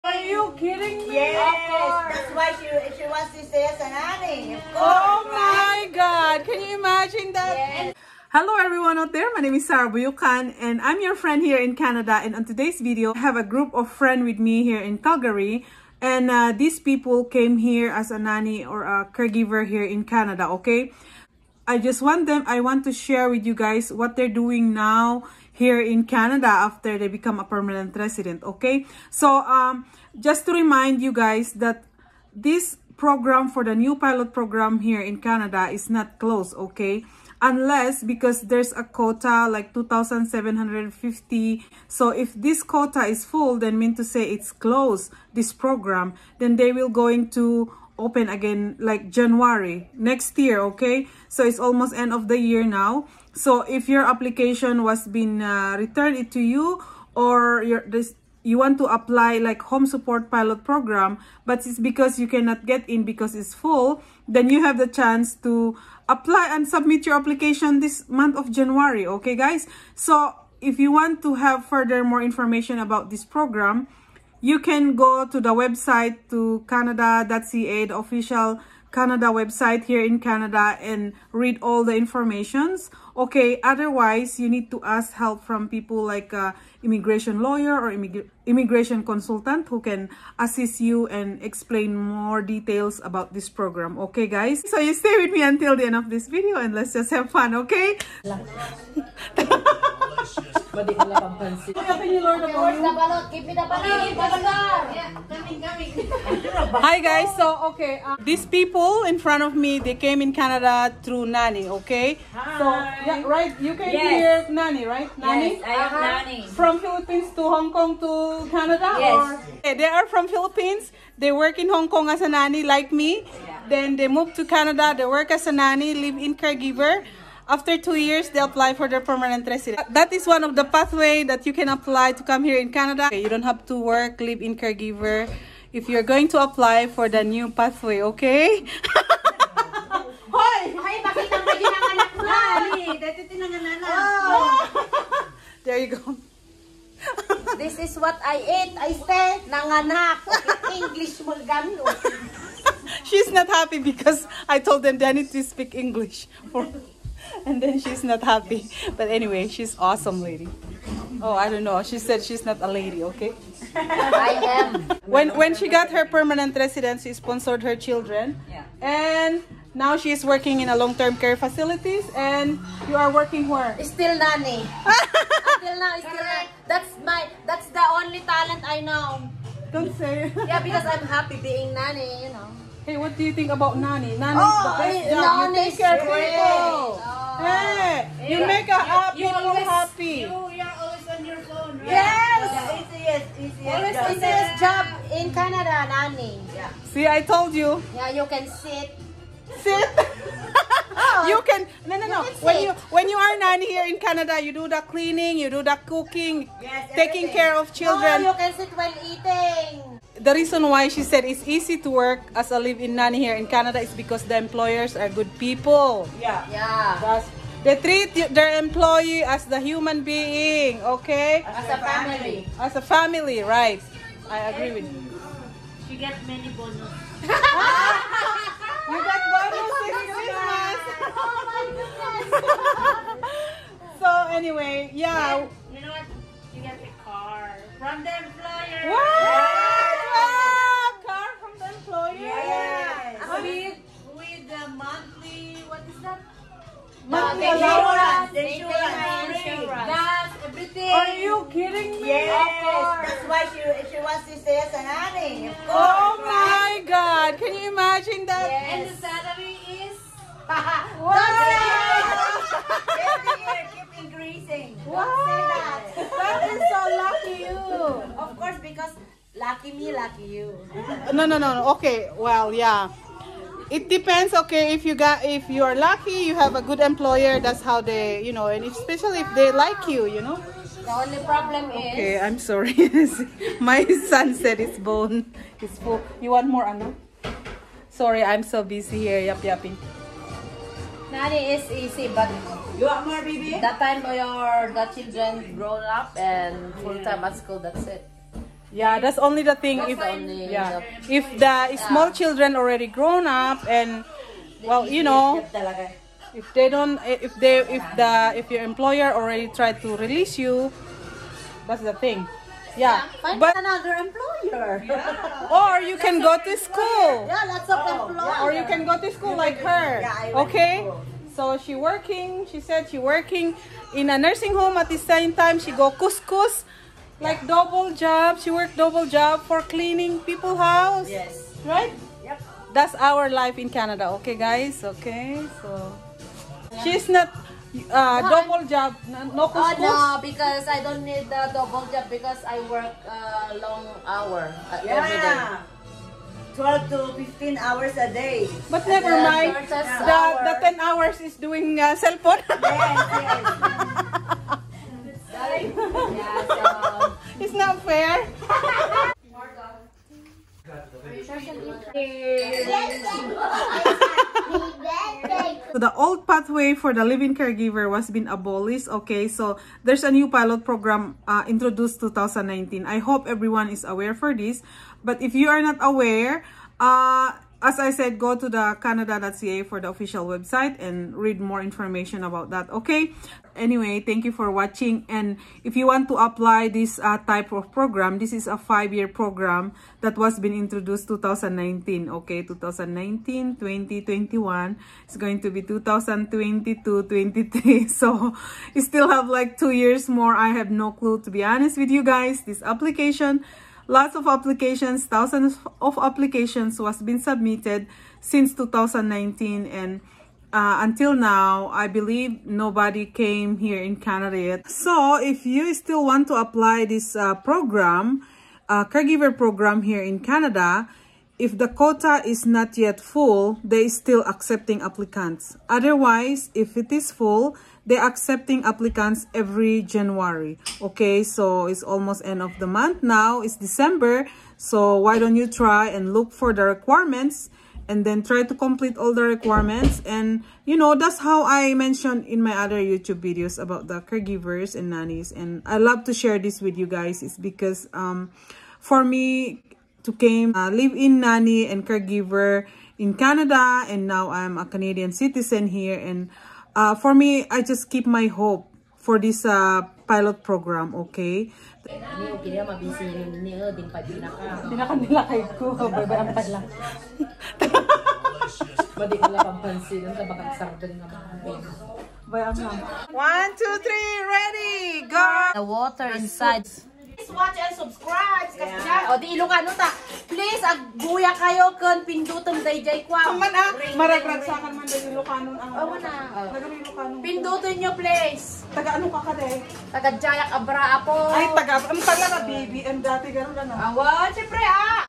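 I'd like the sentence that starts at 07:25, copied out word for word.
And I love to share this with you guys.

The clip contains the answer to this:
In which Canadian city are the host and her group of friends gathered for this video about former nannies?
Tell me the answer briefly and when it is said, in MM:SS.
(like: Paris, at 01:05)
Calgary, at 00:14.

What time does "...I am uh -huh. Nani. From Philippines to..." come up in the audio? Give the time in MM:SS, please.
01:55.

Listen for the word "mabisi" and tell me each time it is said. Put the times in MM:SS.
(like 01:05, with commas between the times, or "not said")
07:42.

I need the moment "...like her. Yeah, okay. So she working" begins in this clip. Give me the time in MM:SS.
05:19.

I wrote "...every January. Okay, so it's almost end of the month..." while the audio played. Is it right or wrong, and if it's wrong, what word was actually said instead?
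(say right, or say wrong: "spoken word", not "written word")
right.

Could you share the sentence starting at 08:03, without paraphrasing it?
man ah, maragragsakan man day Lucanon ang.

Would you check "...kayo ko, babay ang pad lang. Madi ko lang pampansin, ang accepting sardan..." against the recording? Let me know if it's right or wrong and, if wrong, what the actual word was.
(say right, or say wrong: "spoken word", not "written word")
wrong: "tabakang", not "accepting".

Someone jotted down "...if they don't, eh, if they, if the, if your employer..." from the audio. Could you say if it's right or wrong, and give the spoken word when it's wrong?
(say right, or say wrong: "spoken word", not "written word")
right.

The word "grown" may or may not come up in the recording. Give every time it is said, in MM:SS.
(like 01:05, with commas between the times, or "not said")
04:55, 05:02.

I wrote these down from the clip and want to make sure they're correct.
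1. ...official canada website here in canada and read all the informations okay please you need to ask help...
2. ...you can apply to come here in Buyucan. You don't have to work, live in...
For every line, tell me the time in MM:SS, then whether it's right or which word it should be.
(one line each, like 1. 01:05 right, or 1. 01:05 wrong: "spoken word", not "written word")
1. 01:17 wrong: "otherwise", not "please"
2. 02:11 wrong: "Canada", not "Buyucan".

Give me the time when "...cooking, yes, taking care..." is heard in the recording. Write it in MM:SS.
03:25.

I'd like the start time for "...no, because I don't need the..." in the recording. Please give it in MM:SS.
05:39.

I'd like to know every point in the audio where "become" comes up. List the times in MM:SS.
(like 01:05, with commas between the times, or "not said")
00:27.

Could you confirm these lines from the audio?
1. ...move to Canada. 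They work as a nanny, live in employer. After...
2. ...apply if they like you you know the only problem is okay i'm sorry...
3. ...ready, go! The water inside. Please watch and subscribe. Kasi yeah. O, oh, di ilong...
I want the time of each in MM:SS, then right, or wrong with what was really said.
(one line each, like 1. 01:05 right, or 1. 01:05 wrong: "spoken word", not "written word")
1. 02:04 wrong: "caregiver", not "employer"
2. 04:38 wrong: "especially", not "apply"
3. 07:54 right.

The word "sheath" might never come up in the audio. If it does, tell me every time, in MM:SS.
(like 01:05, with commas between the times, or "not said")
not said.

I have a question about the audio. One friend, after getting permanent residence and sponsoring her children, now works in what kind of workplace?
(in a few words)
long-term care facilities.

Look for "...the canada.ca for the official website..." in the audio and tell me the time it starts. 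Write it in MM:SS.
06:18.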